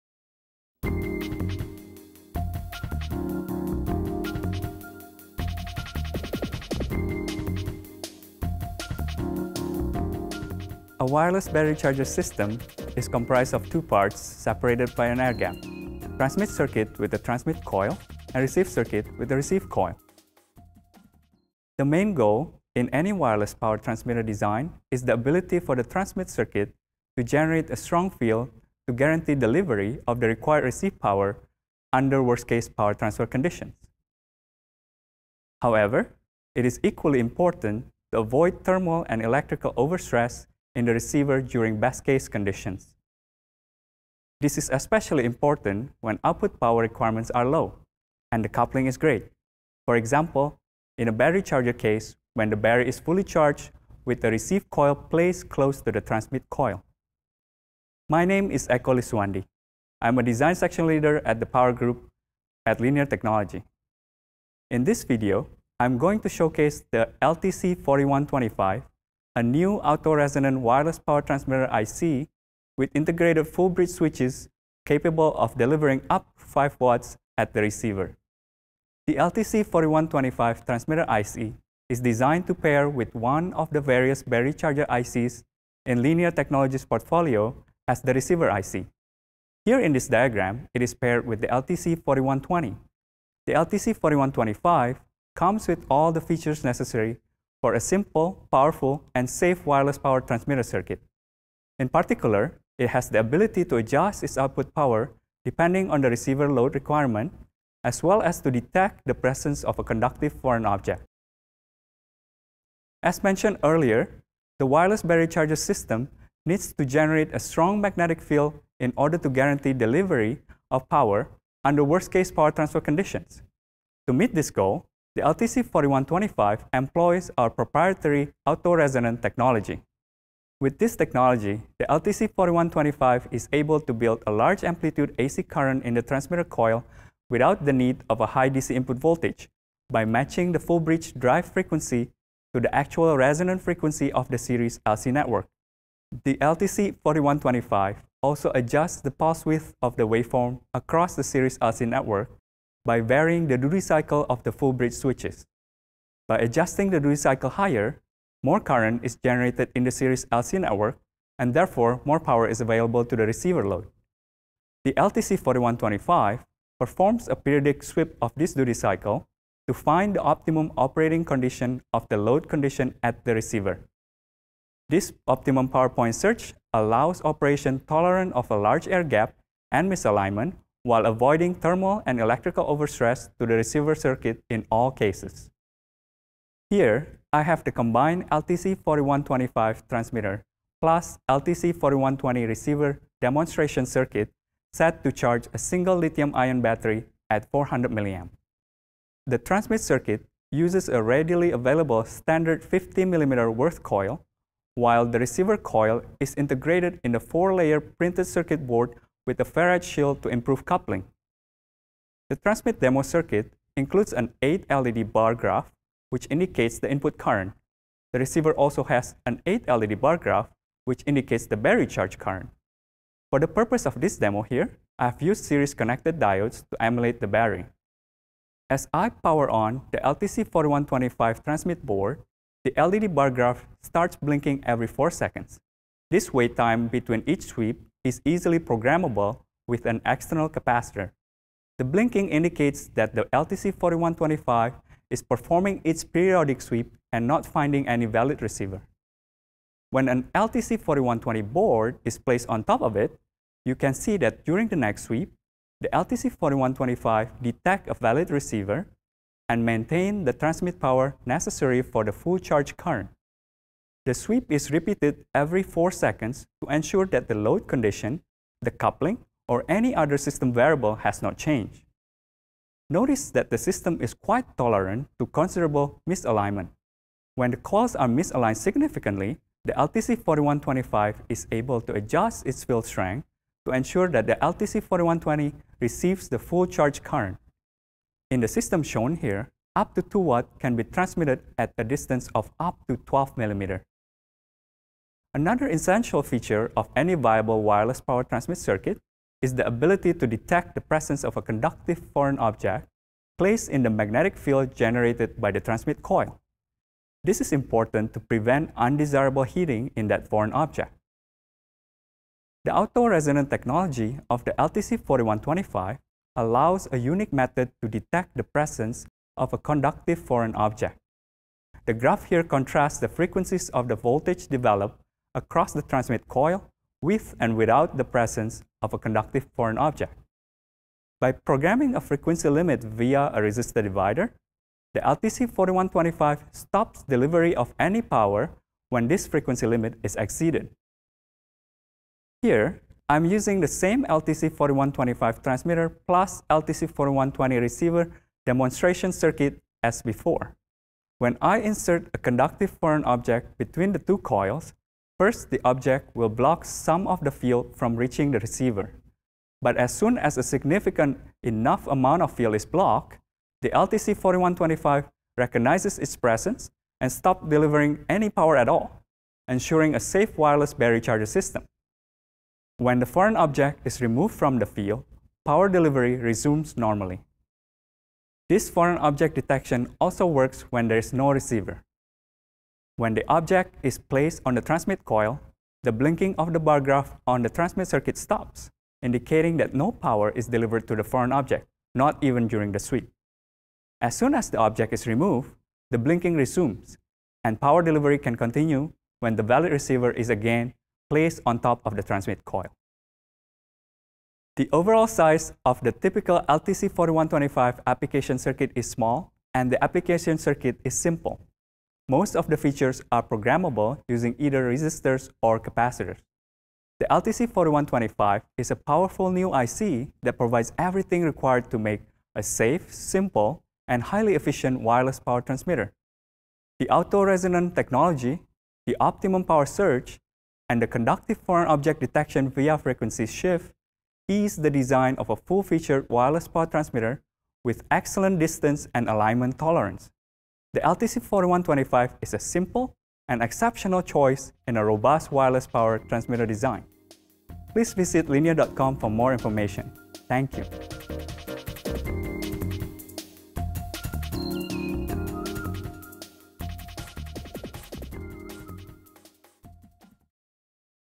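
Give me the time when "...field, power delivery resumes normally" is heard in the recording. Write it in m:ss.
6:14.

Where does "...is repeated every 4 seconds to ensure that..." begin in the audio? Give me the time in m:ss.
4:24.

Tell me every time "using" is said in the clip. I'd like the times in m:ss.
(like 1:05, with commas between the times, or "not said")
5:43, 6:54.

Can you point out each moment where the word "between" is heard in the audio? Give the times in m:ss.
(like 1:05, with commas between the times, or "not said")
3:56, 5:53.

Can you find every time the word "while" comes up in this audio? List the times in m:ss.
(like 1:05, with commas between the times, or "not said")
3:00, 3:24.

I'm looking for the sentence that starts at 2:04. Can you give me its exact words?
To meet this goal, the LTC4125 employs our proprietary auto-resonant technology.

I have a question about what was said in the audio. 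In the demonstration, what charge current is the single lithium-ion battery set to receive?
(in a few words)
400 mA.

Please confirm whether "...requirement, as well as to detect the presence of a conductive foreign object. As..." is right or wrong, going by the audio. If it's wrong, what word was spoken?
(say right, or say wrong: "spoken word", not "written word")
right.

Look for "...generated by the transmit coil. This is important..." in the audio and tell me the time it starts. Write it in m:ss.
5:04.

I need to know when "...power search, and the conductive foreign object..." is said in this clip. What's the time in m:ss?
7:09.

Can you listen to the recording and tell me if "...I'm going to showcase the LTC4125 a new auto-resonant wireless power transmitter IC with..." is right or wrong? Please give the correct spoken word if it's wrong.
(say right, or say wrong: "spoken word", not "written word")
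right.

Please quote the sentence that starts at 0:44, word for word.
This is especially important when output power requirements are low and the coupling is great.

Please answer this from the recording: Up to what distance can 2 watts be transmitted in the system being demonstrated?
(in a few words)
12 millimeters.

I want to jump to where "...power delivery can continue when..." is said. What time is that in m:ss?
6:37.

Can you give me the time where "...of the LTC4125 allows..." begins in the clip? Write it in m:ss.
5:14.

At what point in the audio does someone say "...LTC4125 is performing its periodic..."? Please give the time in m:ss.
4:03.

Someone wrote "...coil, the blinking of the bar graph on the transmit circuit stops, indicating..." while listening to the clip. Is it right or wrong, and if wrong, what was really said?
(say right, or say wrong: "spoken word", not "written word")
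right.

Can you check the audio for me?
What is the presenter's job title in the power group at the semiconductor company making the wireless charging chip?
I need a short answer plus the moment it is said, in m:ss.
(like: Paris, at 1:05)
design section leader, at 1:00.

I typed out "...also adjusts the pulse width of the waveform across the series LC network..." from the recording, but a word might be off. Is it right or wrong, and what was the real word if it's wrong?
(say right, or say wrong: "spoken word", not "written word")
right.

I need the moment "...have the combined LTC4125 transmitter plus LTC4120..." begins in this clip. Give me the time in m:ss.
3:07.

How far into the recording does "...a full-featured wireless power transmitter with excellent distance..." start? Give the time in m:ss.
7:15.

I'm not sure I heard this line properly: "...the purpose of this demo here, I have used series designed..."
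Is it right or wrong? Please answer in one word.
wrong.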